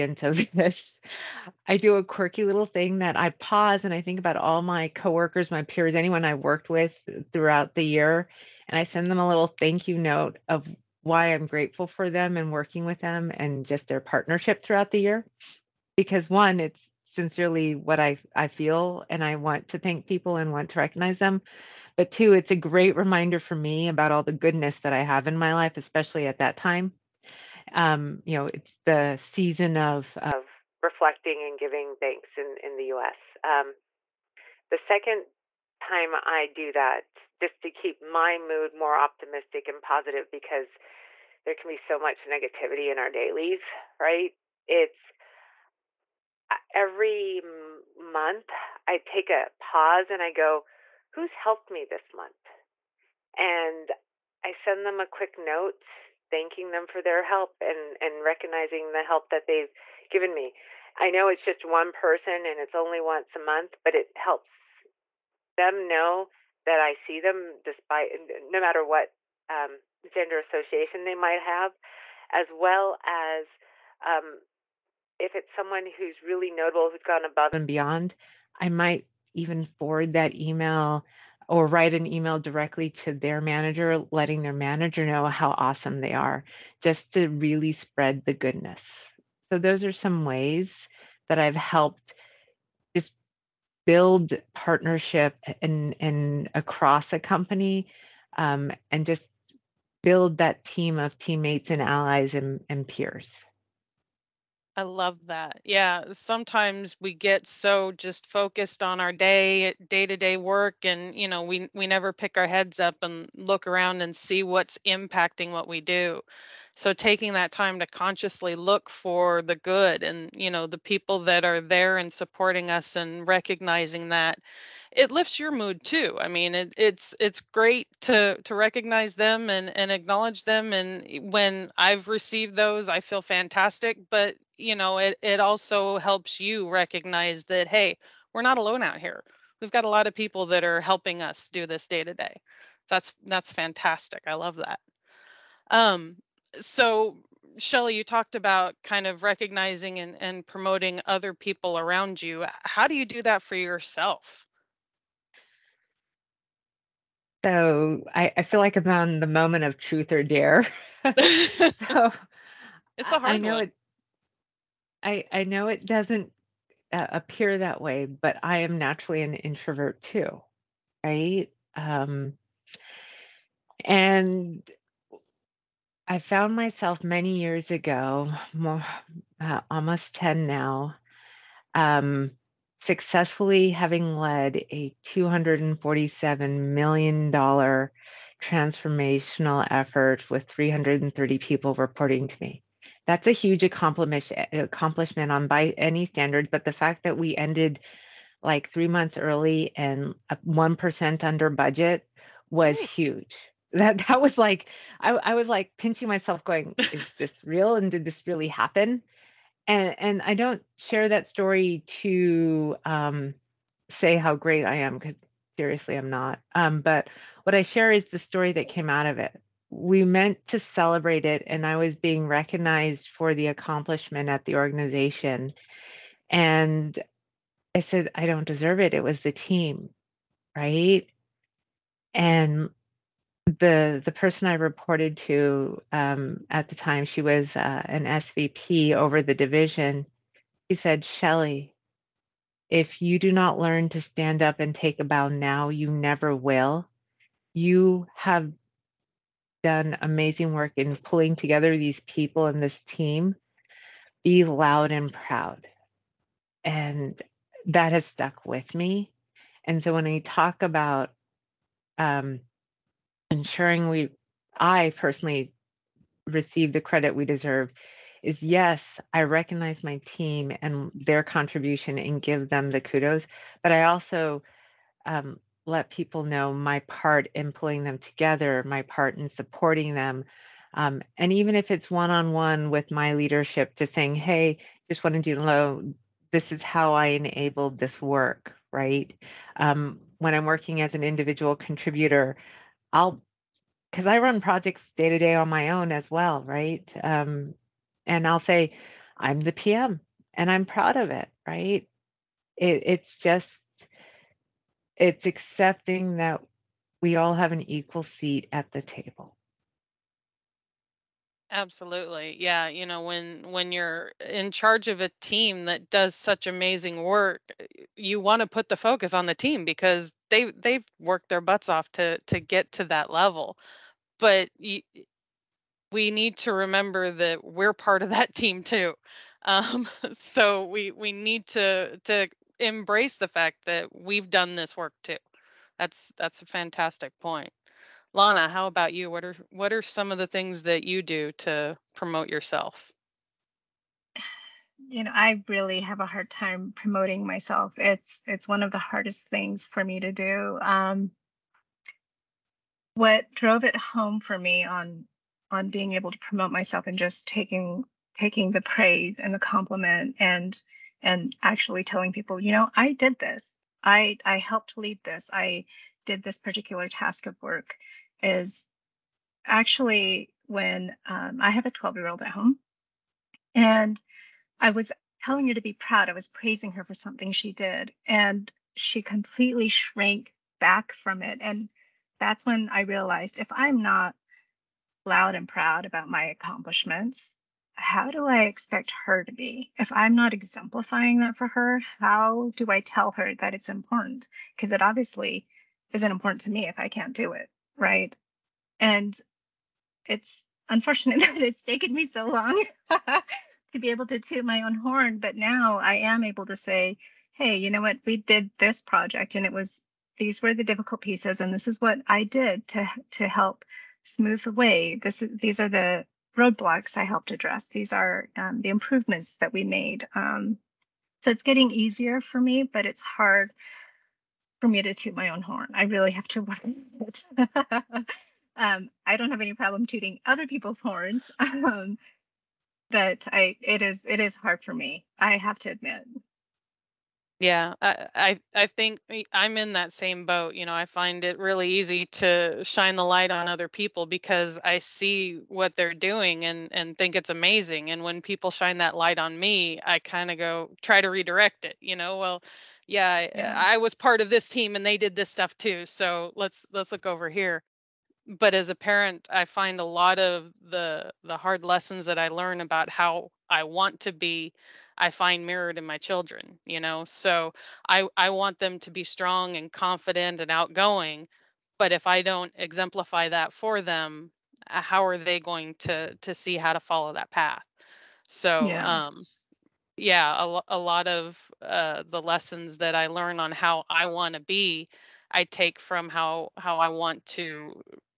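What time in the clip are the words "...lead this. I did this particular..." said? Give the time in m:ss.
6:04.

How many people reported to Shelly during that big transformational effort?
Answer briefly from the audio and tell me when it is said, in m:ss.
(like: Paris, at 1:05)
330, at 3:10.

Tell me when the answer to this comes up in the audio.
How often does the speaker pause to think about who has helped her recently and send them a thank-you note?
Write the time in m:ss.
0:46.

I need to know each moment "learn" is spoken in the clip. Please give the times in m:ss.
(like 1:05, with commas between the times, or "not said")
4:03, 7:42, 8:03.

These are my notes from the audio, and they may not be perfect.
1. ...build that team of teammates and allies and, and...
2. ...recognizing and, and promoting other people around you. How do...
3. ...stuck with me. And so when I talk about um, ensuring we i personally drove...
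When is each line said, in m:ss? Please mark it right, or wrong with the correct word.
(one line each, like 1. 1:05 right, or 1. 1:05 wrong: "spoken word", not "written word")
1. 1:40 right
2. 2:29 right
3. 4:18 wrong: "receive", not "drove".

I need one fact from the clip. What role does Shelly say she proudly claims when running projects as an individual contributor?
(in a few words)
PM.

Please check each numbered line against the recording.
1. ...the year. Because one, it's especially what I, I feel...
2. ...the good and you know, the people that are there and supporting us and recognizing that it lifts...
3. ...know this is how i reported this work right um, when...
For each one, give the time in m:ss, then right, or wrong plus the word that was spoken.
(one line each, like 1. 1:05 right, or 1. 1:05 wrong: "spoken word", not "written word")
1. 0:14 wrong: "sincerely", not "especially"
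2. 1:59 right
3. 4:45 wrong: "enabled", not "reported".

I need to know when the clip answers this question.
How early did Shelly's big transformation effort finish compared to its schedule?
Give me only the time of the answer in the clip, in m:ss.
3:18.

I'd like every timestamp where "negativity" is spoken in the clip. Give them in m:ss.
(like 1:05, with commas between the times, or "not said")
0:42.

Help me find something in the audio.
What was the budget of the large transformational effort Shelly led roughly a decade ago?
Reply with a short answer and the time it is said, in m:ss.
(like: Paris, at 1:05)
$247 million, at 3:05.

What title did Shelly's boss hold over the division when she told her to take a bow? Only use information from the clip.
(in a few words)
SVP.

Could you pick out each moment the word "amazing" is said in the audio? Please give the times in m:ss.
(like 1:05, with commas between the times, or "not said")
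4:10, 5:16, 7:27.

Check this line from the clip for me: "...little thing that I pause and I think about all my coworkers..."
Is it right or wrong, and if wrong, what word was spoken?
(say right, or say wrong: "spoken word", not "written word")
right.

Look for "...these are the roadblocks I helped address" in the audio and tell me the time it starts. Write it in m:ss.
6:55.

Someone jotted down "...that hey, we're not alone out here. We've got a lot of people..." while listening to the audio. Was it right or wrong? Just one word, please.
right.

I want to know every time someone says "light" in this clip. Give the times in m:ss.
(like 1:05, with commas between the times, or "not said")
7:23, 7:28.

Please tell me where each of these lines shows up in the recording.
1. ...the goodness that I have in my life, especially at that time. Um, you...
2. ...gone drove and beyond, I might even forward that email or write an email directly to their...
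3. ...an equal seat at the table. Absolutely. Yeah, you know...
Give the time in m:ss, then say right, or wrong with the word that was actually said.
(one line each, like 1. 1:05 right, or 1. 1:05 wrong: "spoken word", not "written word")
1. 0:24 right
2. 1:17 wrong: "above", not "drove"
3. 5:07 right.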